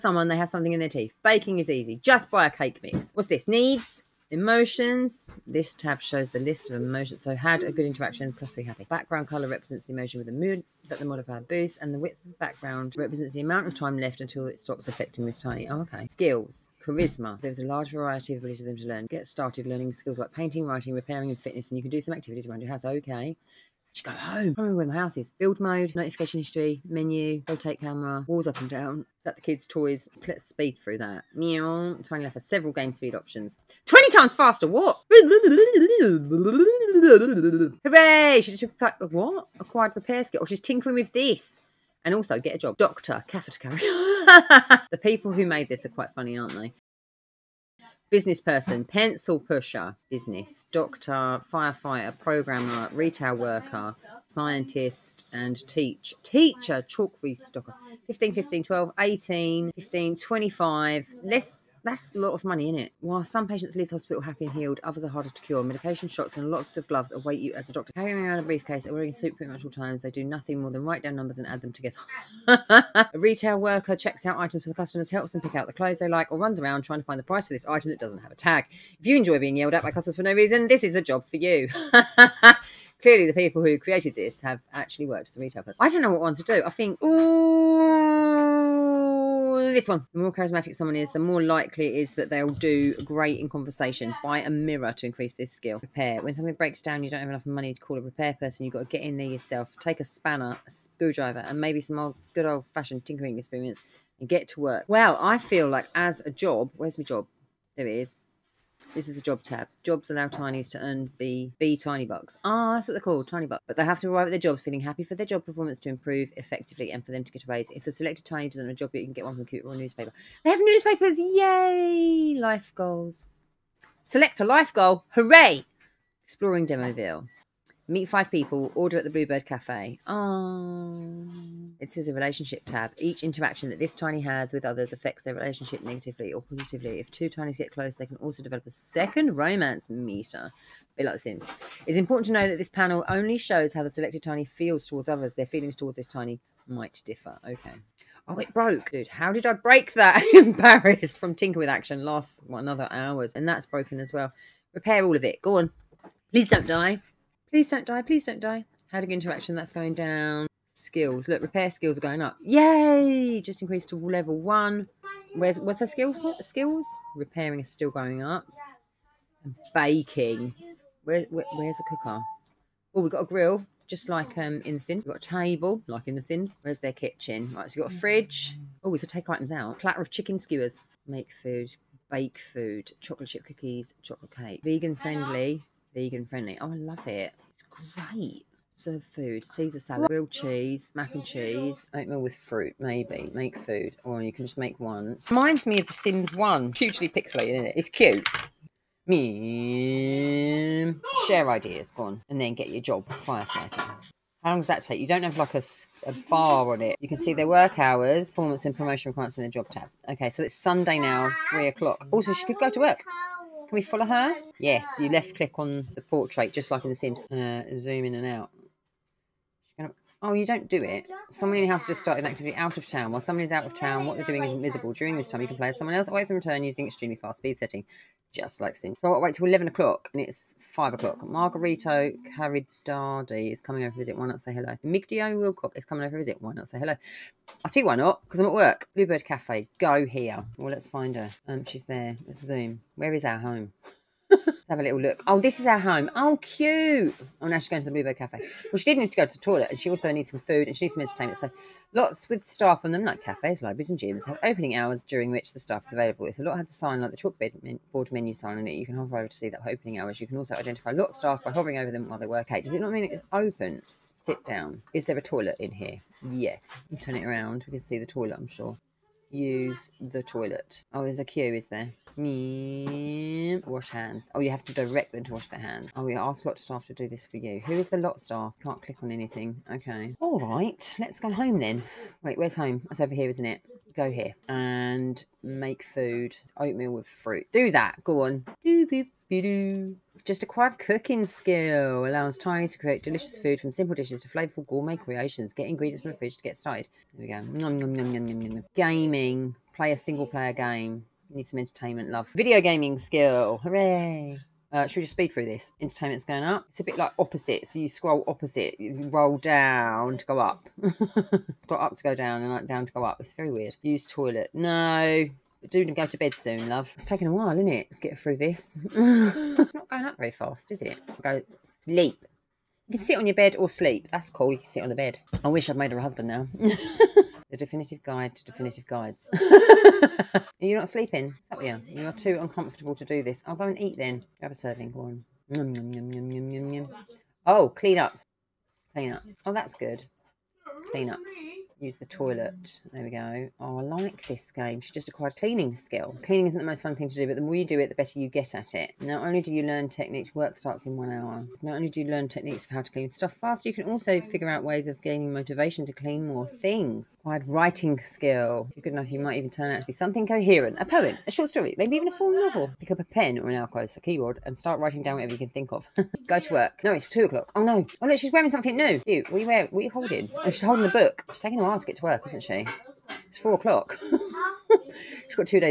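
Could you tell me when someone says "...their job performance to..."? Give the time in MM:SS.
01:55.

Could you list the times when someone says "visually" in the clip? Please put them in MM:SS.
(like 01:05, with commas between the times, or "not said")
not said.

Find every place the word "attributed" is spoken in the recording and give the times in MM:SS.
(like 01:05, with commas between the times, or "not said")
not said.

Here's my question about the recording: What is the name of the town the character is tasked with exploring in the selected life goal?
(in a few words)
Demoville.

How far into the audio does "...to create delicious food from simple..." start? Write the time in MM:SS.
04:52.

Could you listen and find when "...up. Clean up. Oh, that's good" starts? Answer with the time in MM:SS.
05:37.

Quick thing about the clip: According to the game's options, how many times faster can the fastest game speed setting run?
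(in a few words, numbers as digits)
20.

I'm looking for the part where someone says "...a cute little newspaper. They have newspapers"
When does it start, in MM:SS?
01:59.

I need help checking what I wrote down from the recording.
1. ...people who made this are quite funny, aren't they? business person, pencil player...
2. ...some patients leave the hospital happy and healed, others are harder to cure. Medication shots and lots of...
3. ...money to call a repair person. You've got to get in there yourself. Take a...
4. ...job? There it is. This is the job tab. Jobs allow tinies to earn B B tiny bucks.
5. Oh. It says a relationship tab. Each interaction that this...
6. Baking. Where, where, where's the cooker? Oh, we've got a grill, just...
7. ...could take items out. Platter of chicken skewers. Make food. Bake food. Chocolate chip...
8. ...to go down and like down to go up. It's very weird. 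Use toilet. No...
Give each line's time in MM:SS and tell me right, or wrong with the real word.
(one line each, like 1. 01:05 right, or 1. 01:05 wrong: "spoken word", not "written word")
1. 00:45 wrong: "pusher", not "player"
2. 01:03 right
3. 01:37 right
4. 01:47 right
5. 02:10 right
6. 02:49 right
7. 02:58 right
8. 05:11 right.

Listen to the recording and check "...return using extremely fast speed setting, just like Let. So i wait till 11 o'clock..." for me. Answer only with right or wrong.
wrong.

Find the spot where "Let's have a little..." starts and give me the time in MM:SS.
04:04.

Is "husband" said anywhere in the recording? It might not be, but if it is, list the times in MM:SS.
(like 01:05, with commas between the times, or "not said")
05:26.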